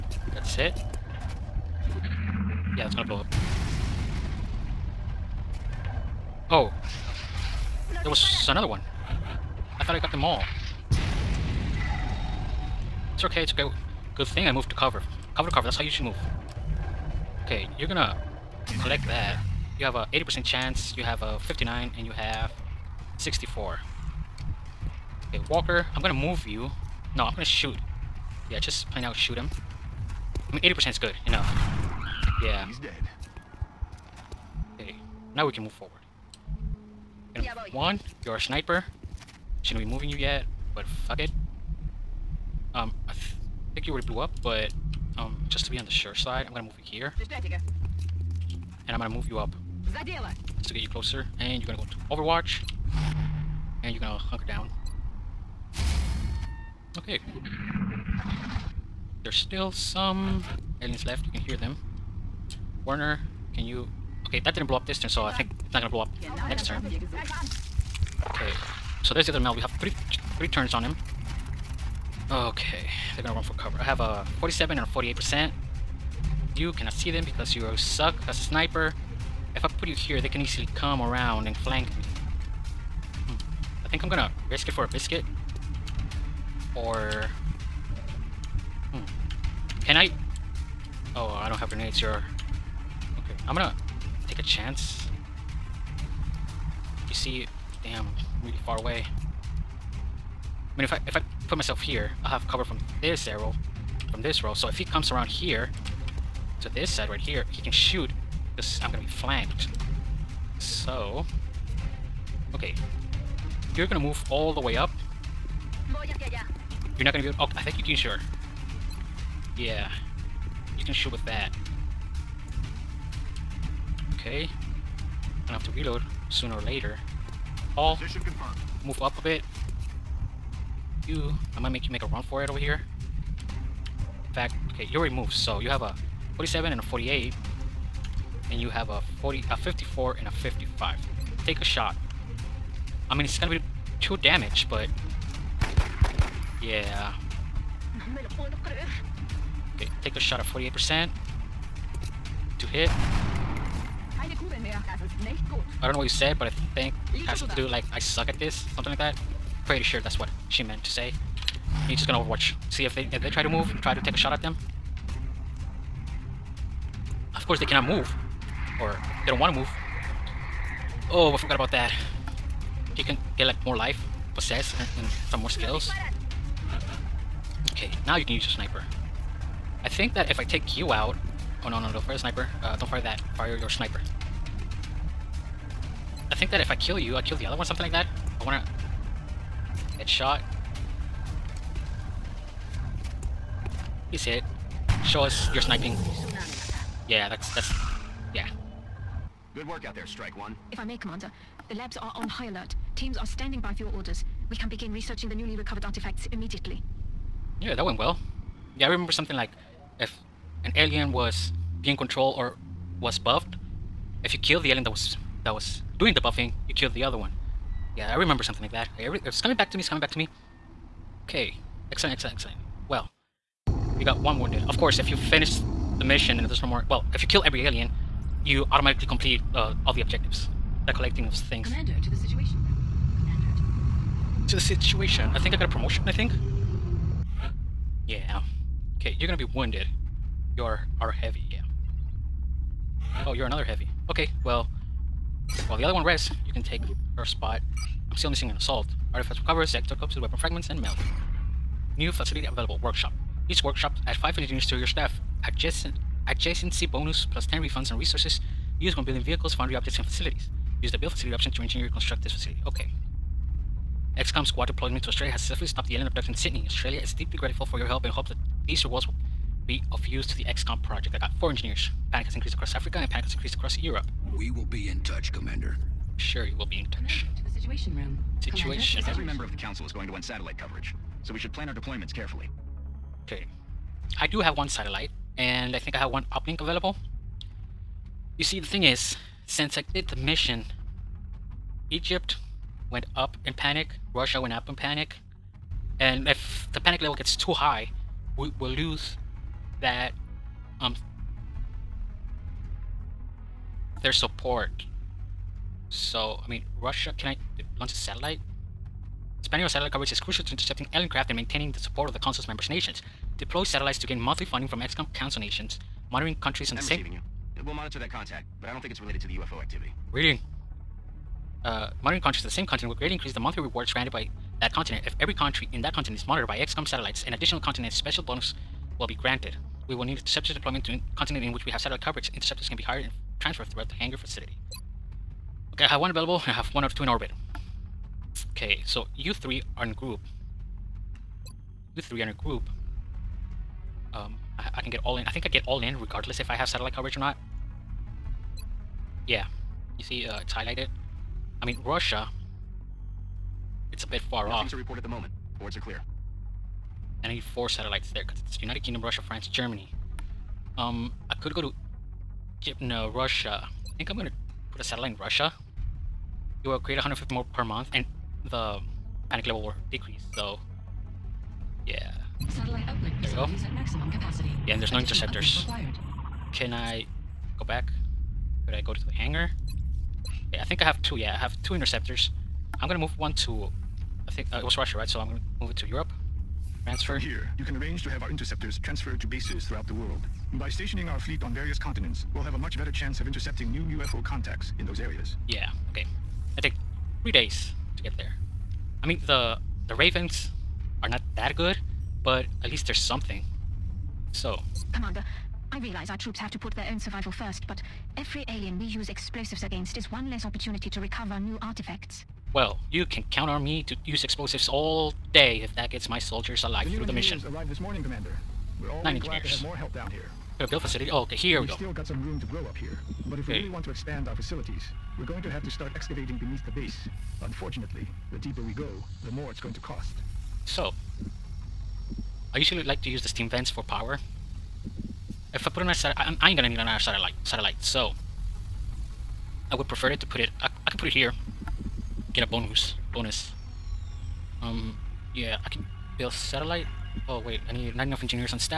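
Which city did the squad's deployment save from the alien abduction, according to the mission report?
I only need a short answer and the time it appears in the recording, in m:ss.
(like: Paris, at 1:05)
Sydney, at 4:26.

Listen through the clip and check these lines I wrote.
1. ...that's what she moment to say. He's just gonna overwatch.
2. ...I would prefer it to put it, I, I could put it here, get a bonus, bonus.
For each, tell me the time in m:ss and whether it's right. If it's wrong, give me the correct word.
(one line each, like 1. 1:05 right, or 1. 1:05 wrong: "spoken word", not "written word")
1. 2:39 wrong: "meant", not "moment"
2. 7:19 right.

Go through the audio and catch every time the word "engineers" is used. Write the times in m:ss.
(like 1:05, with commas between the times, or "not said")
4:14, 4:21, 4:31, 6:59, 7:28.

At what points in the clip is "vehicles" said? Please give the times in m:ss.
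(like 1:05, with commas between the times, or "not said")
4:19.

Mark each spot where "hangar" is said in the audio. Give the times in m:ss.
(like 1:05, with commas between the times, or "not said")
5:33, 6:19.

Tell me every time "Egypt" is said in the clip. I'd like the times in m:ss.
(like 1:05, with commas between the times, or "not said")
4:51, 6:02.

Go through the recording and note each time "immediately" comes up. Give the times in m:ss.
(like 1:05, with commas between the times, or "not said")
3:26.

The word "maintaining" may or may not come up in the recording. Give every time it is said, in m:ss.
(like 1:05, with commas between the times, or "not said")
5:11.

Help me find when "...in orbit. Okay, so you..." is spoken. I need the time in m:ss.
5:37.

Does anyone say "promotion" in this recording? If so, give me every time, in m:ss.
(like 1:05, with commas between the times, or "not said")
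3:55.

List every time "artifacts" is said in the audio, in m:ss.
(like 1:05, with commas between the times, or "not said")
3:25, 4:09, 6:51.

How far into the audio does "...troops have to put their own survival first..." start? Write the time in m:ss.
6:46.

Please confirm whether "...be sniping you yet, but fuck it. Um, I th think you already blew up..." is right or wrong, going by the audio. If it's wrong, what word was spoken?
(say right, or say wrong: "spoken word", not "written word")
wrong: "moving", not "sniping".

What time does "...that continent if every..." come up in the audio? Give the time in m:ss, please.
5:24.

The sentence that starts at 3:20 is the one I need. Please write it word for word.
If I may, Commander, the labs are on high alert.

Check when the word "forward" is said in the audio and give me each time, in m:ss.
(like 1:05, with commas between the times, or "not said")
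0:35.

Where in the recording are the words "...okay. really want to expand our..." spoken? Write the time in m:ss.
7:03.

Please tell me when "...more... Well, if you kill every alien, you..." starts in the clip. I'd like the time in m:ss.
3:46.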